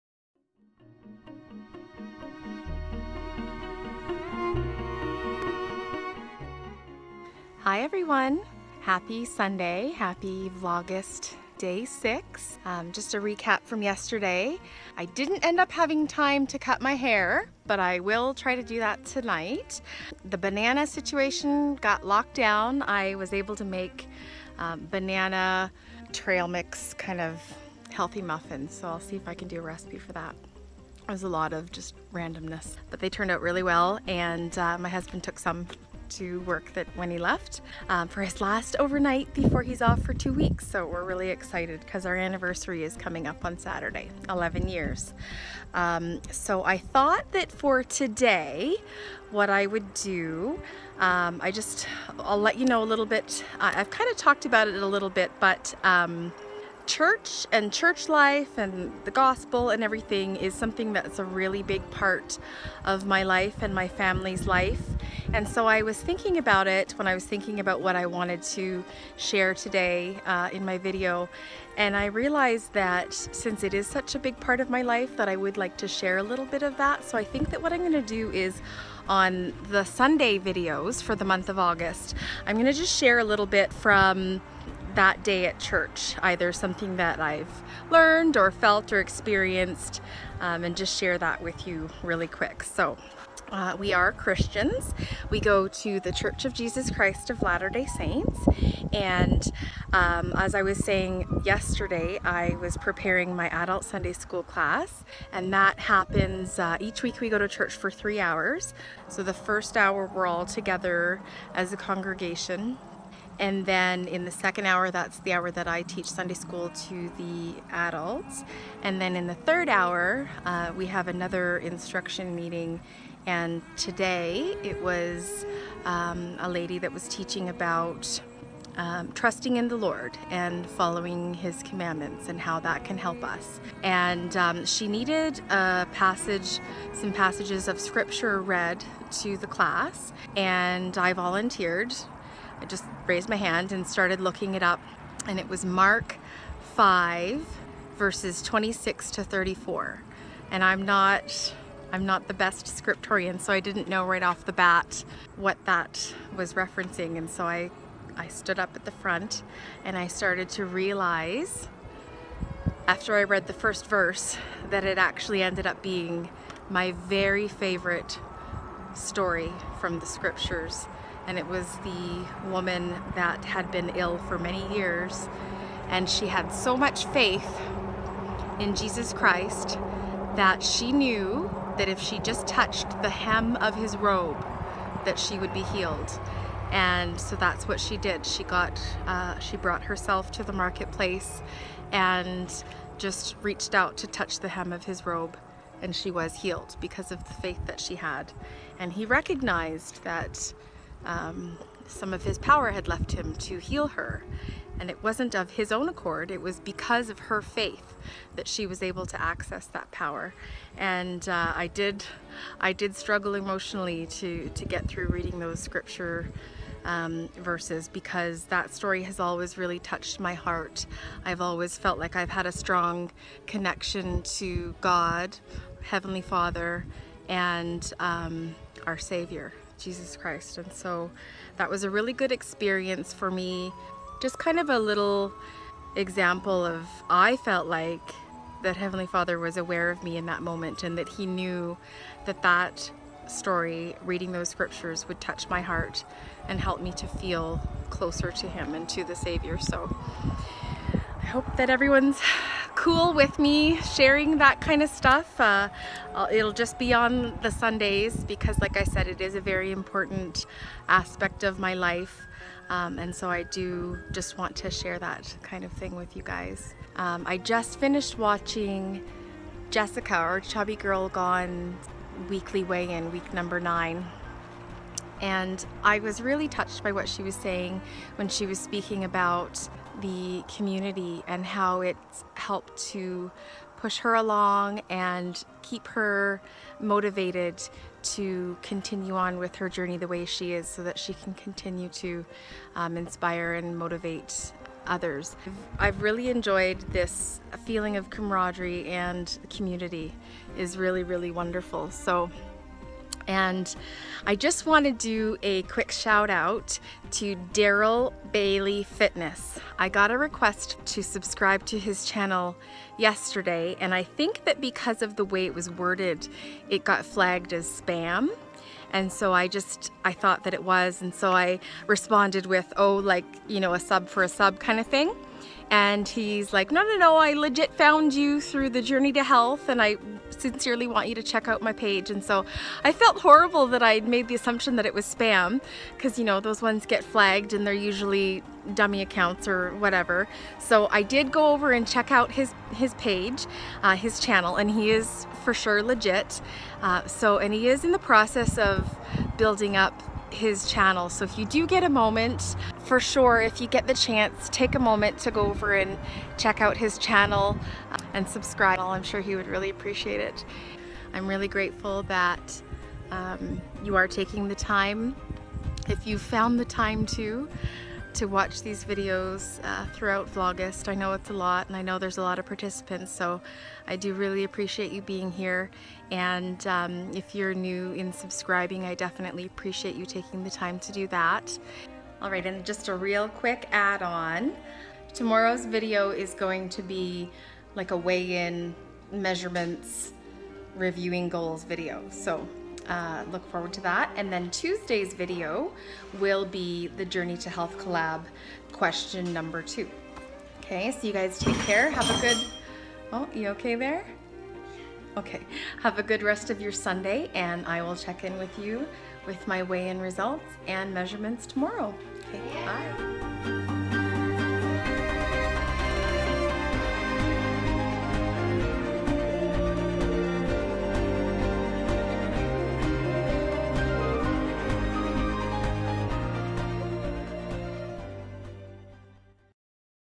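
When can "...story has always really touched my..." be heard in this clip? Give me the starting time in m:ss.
3:38.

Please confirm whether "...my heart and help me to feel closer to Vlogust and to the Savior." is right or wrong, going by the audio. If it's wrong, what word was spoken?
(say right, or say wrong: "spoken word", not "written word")
wrong: "Him", not "Vlogust".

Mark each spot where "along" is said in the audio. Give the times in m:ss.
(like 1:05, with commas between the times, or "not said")
4:44.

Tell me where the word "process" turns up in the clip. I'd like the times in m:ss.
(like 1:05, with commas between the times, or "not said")
5:47.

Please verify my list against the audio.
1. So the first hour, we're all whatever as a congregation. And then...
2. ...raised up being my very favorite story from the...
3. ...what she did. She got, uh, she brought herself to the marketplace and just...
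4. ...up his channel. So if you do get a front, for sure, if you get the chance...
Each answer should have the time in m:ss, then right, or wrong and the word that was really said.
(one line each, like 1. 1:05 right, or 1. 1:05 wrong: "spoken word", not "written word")
1. 1:49 wrong: "together", not "whatever"
2. 2:45 wrong: "ended", not "raised"
3. 3:07 right
4. 5:49 wrong: "moment", not "front".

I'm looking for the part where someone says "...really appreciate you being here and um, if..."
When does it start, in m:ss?
6:14.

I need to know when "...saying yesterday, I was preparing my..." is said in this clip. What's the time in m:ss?
1:40.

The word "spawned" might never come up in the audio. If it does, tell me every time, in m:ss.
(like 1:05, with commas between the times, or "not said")
not said.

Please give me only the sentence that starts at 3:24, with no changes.
And it wasn't of his own accord, it was because of her faith that she was able to access that power.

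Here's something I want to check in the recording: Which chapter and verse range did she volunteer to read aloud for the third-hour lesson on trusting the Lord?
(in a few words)
Mark 5:26-34.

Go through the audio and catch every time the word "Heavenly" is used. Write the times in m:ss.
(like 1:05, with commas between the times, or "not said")
3:45, 3:58.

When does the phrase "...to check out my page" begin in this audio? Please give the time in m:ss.
5:31.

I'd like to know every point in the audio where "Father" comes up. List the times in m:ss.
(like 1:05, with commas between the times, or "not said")
3:46, 3:59.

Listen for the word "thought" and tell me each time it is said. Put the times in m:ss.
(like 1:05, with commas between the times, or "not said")
0:46, 5:20.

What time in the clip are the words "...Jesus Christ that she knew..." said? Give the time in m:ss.
2:58.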